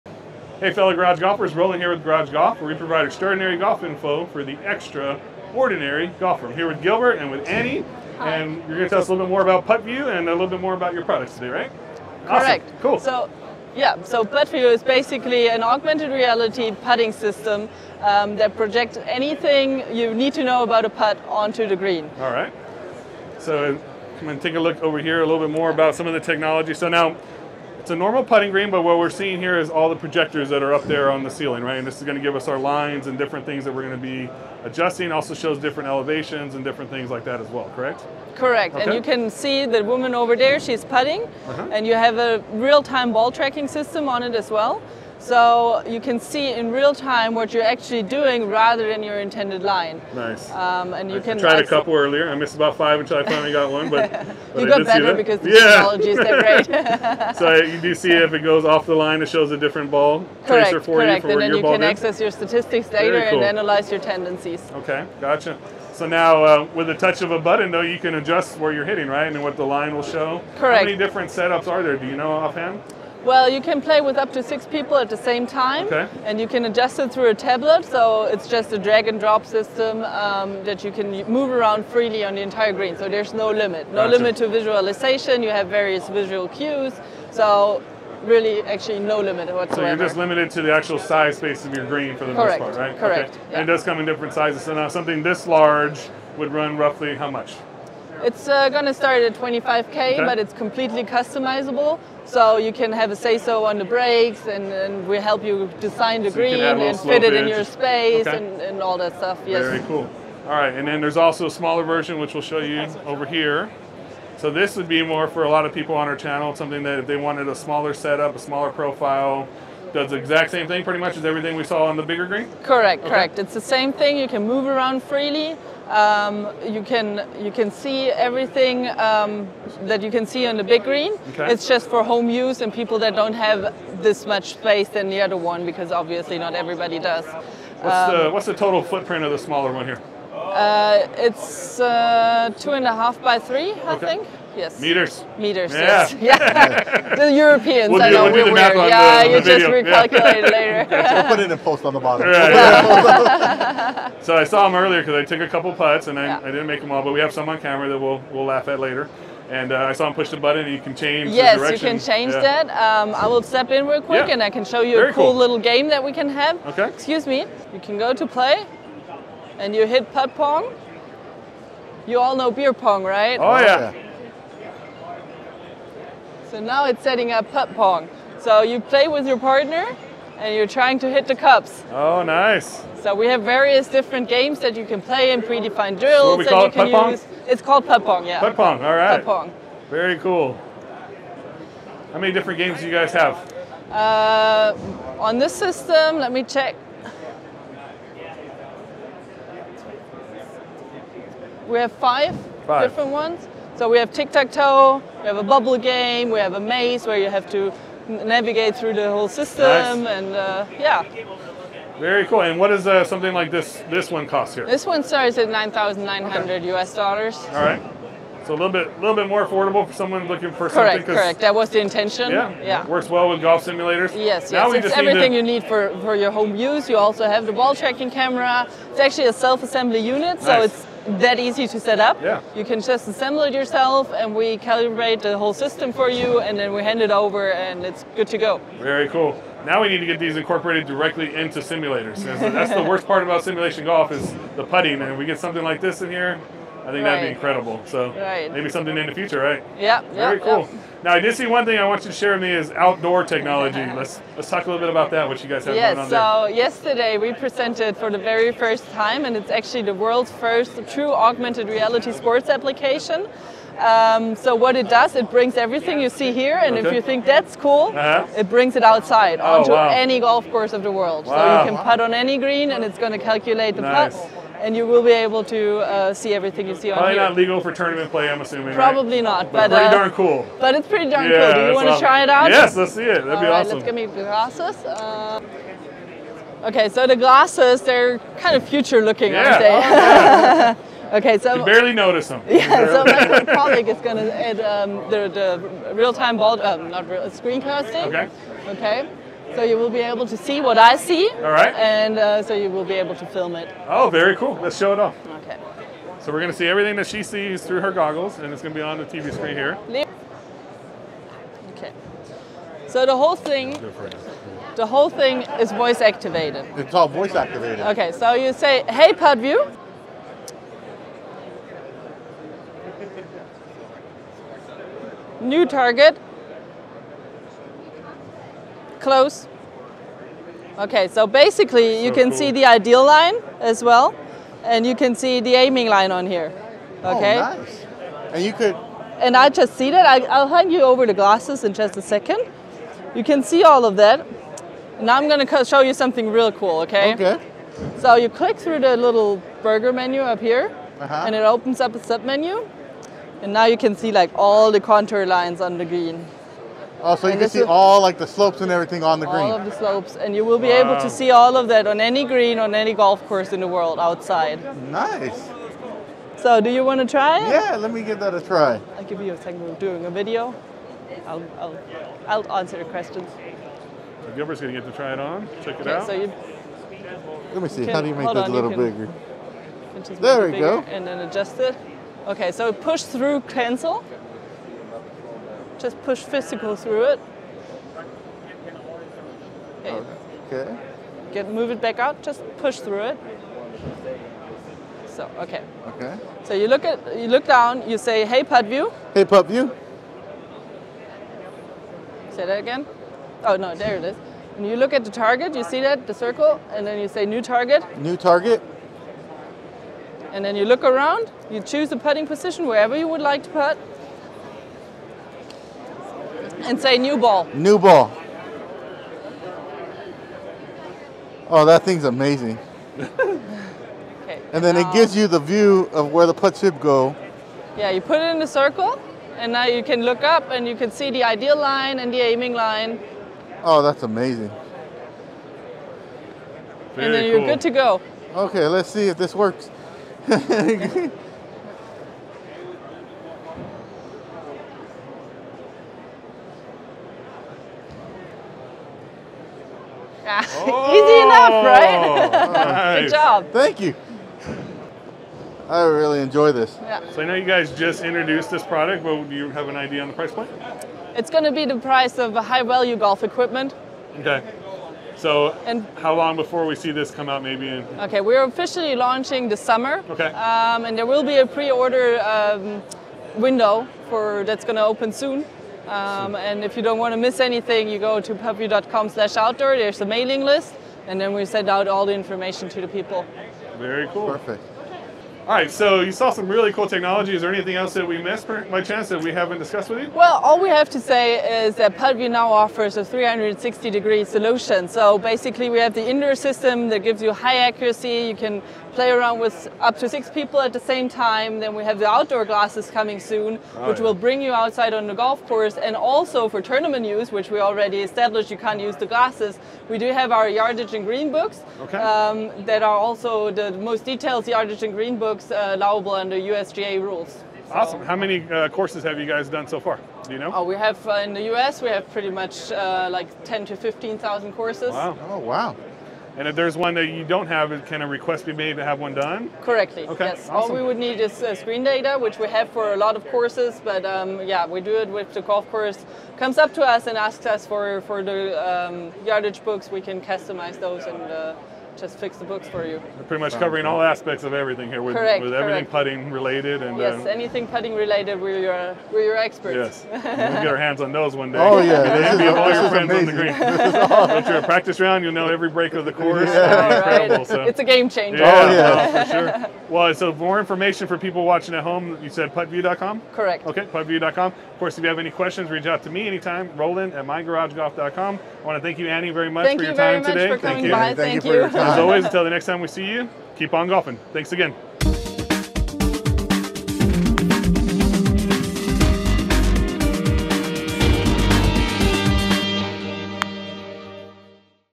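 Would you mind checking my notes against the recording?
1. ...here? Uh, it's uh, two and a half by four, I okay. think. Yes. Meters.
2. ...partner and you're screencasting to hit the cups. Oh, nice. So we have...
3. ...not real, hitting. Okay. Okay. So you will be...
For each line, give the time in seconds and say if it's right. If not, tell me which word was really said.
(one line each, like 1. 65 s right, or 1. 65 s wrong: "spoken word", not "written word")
1. 139 s wrong: "three", not "four"
2. 179 s wrong: "trying", not "screencasting"
3. 296 s wrong: "screencasting", not "hitting".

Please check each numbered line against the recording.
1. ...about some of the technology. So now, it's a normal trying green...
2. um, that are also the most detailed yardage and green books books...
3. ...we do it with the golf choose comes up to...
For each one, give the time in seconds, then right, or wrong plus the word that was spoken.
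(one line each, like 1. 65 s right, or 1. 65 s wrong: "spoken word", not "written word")
1. 25 s wrong: "putting", not "trying"
2. 511 s right
3. 534 s wrong: "course", not "choose".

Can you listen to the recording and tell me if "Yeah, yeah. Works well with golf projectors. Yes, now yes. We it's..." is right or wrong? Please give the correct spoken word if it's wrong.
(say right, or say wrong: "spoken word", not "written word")
wrong: "simulators", not "projectors".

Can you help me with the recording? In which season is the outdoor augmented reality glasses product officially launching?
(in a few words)
Summer.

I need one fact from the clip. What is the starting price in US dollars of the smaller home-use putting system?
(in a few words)
$9,900.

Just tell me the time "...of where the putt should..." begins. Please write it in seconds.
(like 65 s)
425 s.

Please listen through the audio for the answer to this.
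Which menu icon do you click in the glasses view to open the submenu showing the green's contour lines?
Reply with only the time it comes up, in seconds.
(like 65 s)
349 s.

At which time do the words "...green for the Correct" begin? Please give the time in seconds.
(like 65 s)
91 s.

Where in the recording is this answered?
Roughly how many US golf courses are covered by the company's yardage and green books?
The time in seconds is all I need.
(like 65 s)
523 s.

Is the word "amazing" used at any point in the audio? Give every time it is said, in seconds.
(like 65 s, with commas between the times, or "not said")
422 s, 434 s, 553 s.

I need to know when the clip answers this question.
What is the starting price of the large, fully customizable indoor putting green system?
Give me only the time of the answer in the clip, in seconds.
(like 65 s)
99 s.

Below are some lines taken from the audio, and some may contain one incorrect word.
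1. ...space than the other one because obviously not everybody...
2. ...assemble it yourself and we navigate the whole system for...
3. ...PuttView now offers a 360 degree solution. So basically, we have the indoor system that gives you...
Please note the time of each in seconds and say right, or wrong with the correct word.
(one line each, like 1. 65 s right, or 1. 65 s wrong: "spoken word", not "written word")
1. 134 s right
2. 233 s wrong: "calibrate", not "navigate"
3. 491 s right.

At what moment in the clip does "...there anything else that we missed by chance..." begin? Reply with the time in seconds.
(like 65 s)
487 s.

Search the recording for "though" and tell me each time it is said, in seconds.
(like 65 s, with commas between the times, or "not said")
67 s.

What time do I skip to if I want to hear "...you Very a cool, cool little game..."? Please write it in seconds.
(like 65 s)
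164 s.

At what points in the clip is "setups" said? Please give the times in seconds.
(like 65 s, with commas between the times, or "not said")
71 s, 117 s.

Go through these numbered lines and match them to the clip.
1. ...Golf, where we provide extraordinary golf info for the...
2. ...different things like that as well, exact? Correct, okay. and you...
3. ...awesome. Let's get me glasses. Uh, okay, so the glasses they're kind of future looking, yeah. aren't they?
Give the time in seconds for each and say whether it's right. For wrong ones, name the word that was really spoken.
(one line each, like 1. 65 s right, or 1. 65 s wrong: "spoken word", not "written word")
1. 2 s right
2. 36 s wrong: "correct", not "exact"
3. 283 s right.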